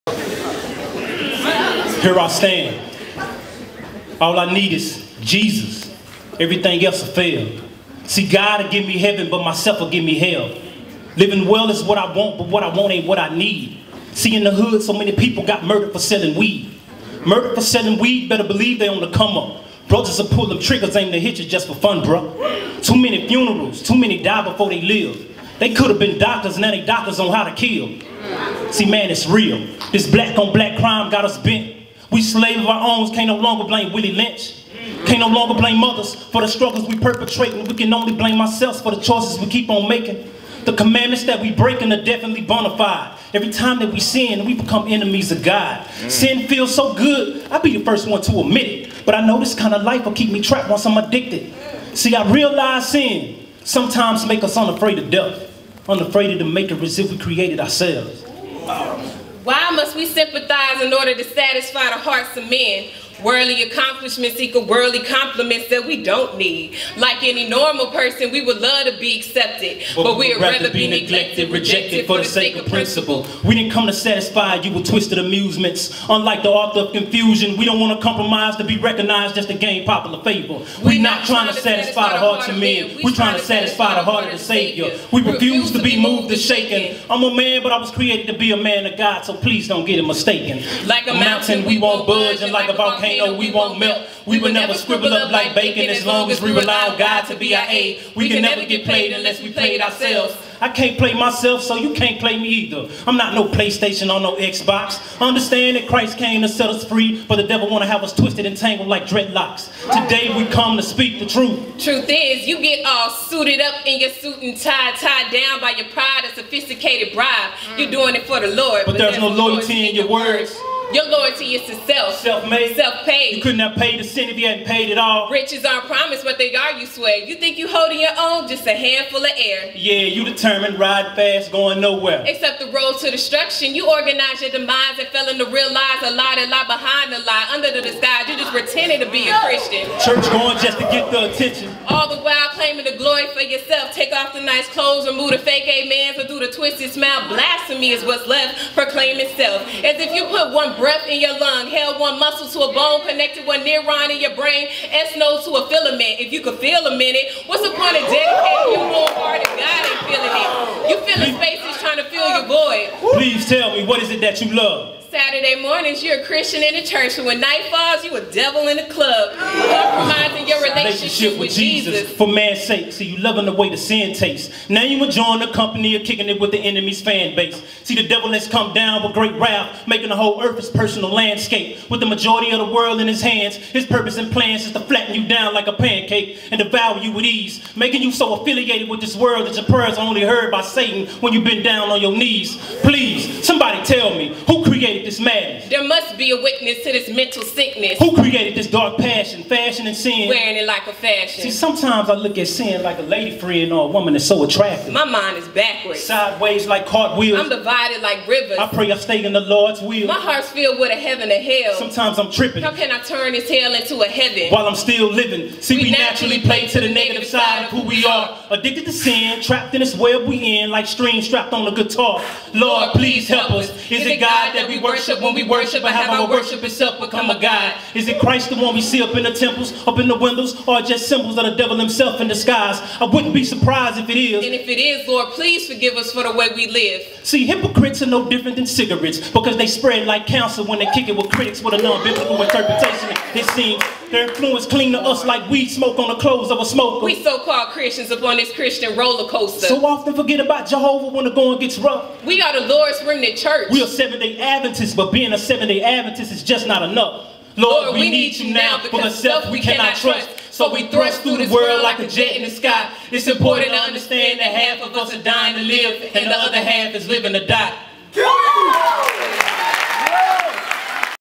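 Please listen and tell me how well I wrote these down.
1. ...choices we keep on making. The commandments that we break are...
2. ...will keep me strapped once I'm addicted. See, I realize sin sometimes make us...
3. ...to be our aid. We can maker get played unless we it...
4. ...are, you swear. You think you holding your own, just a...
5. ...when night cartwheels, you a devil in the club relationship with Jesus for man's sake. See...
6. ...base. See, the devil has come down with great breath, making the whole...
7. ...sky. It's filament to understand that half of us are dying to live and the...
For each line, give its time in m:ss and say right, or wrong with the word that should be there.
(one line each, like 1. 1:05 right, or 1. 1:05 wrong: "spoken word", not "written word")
1. 0:39 right
2. 0:50 wrong: "trapped", not "strapped"
3. 1:37 wrong: "never", not "maker"
4. 2:06 right
5. 2:47 wrong: "falls", not "cartwheels"
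6. 2:57 wrong: "wrath", not "breath"
7. 4:22 wrong: "important", not "filament".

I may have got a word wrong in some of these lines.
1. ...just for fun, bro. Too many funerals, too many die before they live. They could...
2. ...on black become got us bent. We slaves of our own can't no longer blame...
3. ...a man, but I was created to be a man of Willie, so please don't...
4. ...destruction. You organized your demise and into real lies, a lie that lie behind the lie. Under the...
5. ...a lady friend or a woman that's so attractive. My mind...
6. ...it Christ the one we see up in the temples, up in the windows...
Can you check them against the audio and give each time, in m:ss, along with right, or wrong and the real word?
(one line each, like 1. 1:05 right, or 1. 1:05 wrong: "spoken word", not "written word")
1. 0:21 right
2. 0:30 wrong: "crime", not "become"
3. 1:27 wrong: "God", not "Willie"
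4. 2:13 right
5. 3:22 right
6. 3:48 right.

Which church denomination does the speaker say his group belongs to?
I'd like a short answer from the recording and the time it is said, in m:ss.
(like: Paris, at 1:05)
Seventh-day Adventist, at 4:13.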